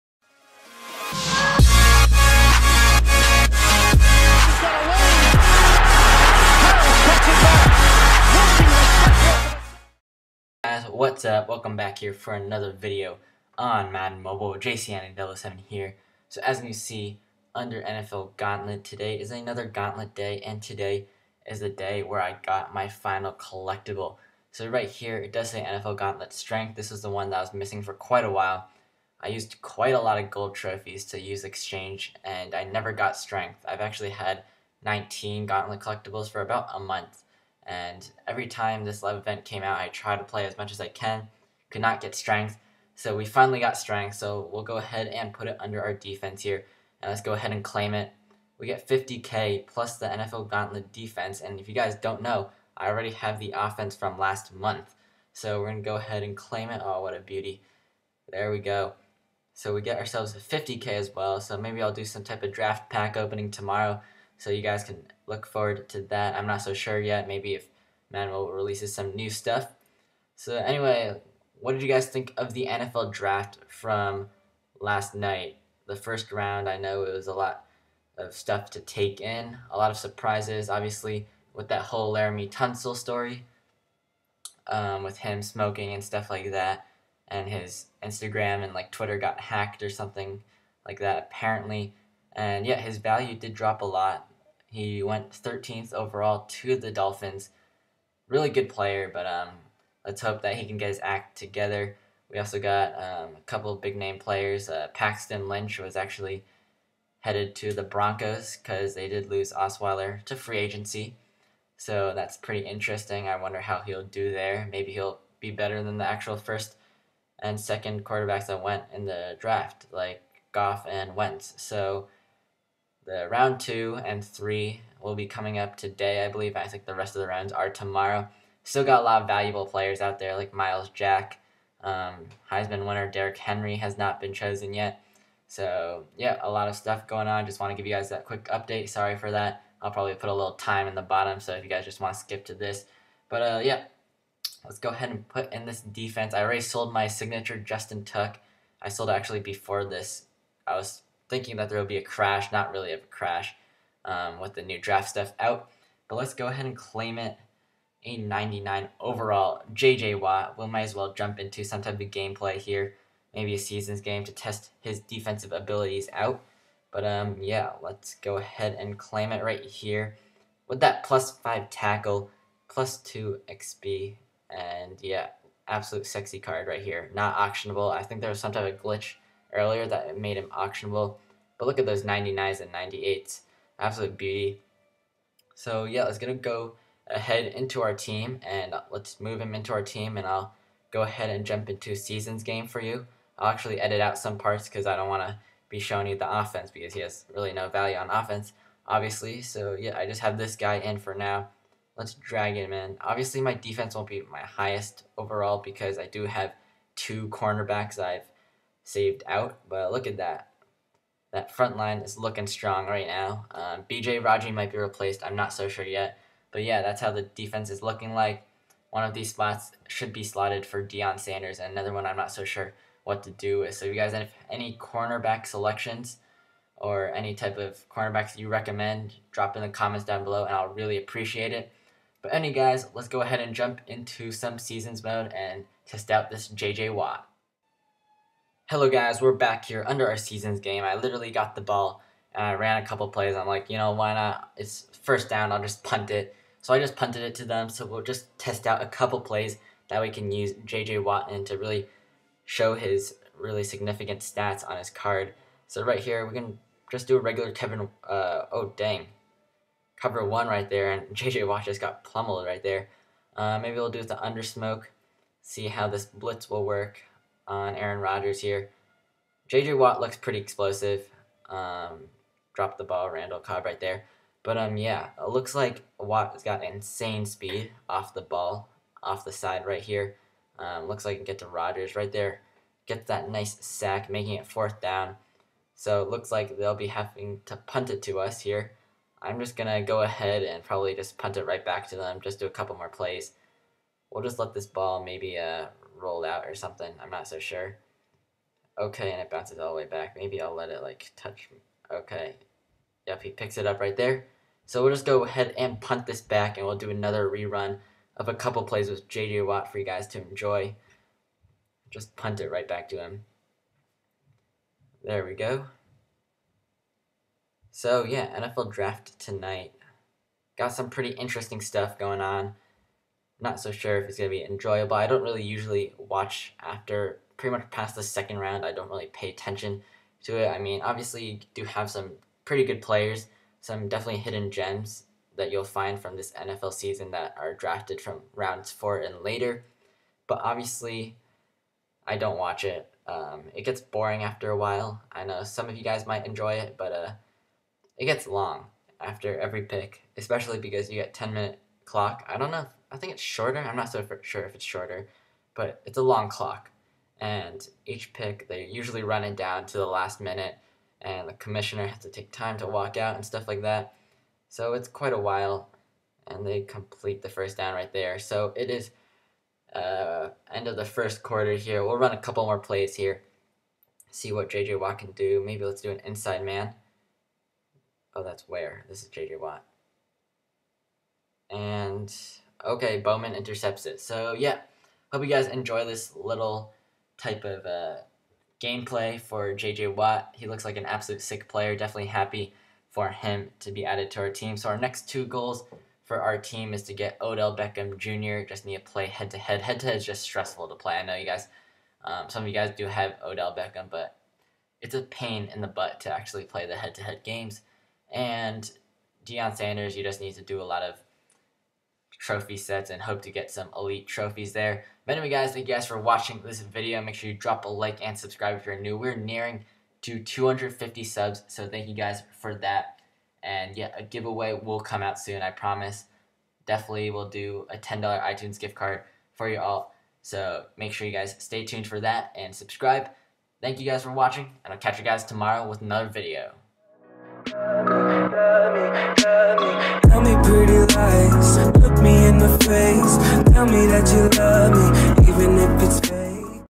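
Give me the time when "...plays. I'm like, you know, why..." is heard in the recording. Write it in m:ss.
4:03.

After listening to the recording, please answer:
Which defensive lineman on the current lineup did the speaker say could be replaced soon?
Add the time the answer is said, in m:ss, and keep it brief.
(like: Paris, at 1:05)
BJ Raji, at 3:33.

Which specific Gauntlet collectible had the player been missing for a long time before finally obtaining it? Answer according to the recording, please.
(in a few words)
NFL Gauntlet Strength.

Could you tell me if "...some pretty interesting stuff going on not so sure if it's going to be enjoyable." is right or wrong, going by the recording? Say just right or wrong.
right.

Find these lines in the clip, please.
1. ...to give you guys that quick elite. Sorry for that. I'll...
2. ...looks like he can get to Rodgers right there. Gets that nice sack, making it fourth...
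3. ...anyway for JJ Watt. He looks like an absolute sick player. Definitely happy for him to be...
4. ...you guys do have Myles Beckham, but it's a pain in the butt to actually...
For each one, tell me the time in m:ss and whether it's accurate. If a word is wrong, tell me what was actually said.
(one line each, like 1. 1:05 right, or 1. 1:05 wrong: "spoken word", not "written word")
1. 2:17 wrong: "update", not "elite"
2. 4:40 right
3. 6:28 wrong: "gameplay", not "anyway"
4. 6:42 wrong: "Odell", not "Myles".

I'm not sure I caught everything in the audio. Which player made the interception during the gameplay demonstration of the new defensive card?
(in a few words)
Bowman.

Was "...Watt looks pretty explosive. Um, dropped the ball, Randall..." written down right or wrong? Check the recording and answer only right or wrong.
right.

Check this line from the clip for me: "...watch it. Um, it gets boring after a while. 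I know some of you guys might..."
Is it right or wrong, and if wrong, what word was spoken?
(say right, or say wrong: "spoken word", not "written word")
right.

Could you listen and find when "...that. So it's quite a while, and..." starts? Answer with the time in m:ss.
6:03.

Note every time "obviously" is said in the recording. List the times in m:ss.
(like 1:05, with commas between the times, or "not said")
1:20, 3:18, 3:23, 5:30, 5:40.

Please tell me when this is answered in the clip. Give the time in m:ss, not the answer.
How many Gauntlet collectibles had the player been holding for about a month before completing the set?
0:34.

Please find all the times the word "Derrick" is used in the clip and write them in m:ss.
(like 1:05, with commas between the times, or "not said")
2:13.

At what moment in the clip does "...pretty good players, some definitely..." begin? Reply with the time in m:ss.
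5:32.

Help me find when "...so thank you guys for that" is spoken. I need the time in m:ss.
7:01.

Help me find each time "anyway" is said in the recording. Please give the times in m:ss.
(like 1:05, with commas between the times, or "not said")
1:10, 3:52, 6:55.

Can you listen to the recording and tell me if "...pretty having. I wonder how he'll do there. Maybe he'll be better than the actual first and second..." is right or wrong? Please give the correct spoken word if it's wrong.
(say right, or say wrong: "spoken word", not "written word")
wrong: "interesting", not "having".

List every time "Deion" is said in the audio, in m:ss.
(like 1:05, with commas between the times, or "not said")
3:40, 6:49.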